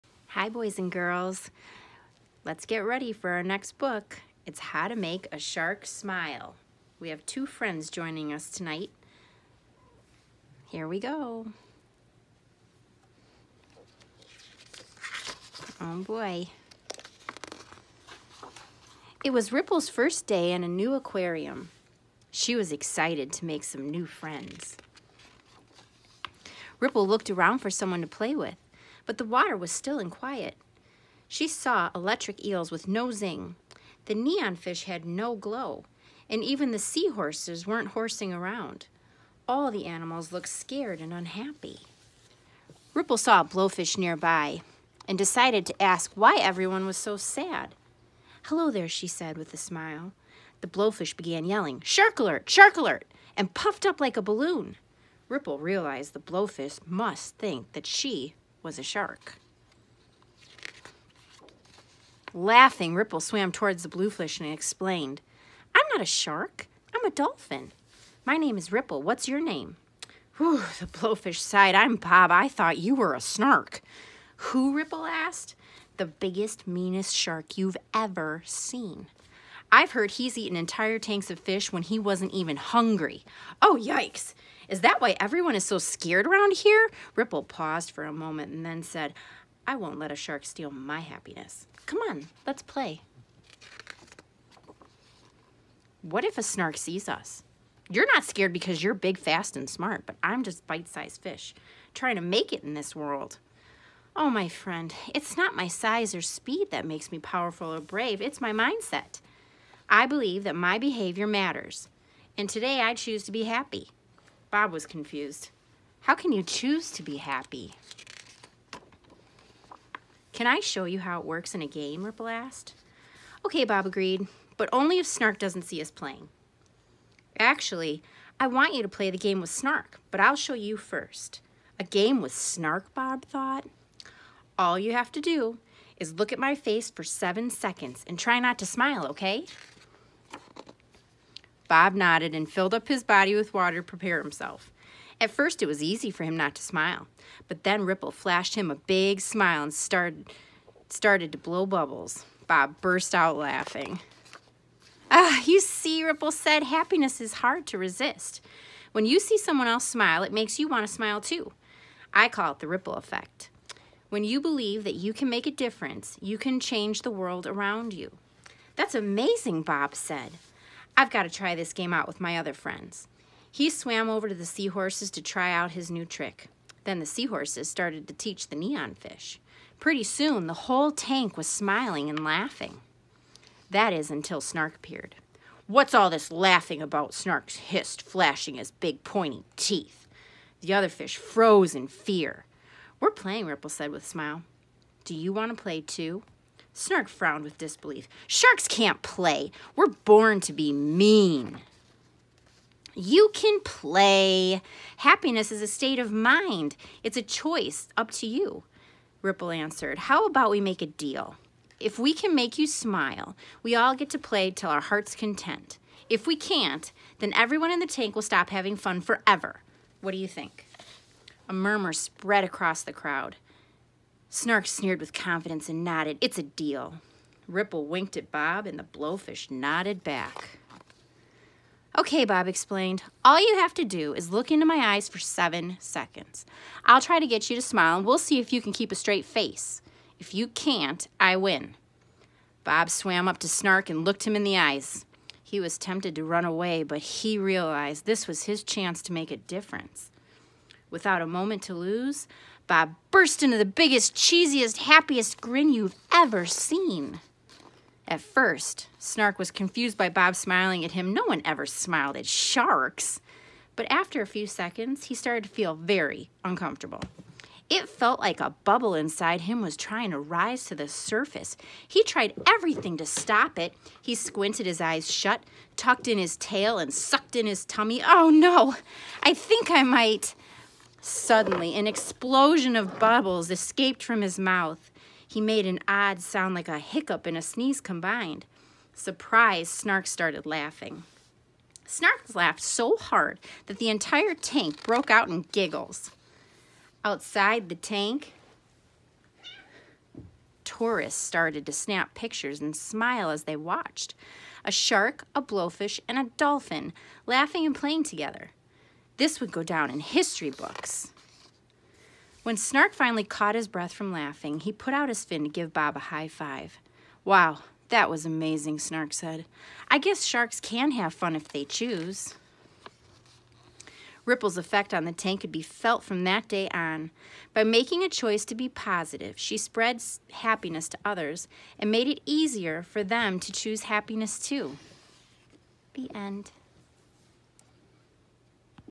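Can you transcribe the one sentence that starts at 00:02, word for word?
Let's get ready for our next book.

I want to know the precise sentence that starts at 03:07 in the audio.
Snark hissed, flashing his big pointy teeth.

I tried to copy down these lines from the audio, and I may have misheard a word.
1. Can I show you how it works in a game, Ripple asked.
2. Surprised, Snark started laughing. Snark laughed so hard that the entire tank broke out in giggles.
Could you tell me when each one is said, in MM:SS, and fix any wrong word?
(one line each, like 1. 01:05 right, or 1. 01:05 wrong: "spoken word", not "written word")
1. 02:00 right
2. 04:48 right.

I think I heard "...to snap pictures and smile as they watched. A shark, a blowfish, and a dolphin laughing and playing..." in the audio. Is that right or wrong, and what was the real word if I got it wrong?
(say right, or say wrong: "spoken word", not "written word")
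right.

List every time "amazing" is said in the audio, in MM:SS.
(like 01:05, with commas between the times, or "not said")
02:48, 05:18.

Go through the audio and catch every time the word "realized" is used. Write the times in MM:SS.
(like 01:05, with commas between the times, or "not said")
00:55, 04:07.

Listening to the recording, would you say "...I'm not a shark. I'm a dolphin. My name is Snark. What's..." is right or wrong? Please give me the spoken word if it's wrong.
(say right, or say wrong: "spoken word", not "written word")
wrong: "Ripple", not "Snark".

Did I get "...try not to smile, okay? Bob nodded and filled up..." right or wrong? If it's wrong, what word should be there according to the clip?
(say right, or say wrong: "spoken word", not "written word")
right.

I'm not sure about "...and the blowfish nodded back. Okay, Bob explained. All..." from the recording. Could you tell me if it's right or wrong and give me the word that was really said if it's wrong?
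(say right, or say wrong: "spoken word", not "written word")
right.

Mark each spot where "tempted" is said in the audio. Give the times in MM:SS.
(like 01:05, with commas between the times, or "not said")
04:05.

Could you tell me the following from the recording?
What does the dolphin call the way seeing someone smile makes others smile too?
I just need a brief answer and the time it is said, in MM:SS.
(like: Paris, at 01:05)
The ripple effect, at 02:42.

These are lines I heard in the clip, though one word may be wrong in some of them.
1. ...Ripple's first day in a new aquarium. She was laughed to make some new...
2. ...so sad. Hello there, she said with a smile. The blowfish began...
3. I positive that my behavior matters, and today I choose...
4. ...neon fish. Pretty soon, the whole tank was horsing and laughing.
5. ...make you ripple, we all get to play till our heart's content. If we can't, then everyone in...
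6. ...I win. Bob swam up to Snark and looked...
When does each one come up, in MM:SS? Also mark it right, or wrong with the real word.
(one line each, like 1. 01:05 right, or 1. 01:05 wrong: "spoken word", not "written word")
1. 00:19 wrong: "excited", not "laughed"
2. 00:46 right
3. 01:49 wrong: "believe", not "positive"
4. 02:58 wrong: "smiling", not "horsing"
5. 03:32 wrong: "smile", not "ripple"
6. 04:01 right.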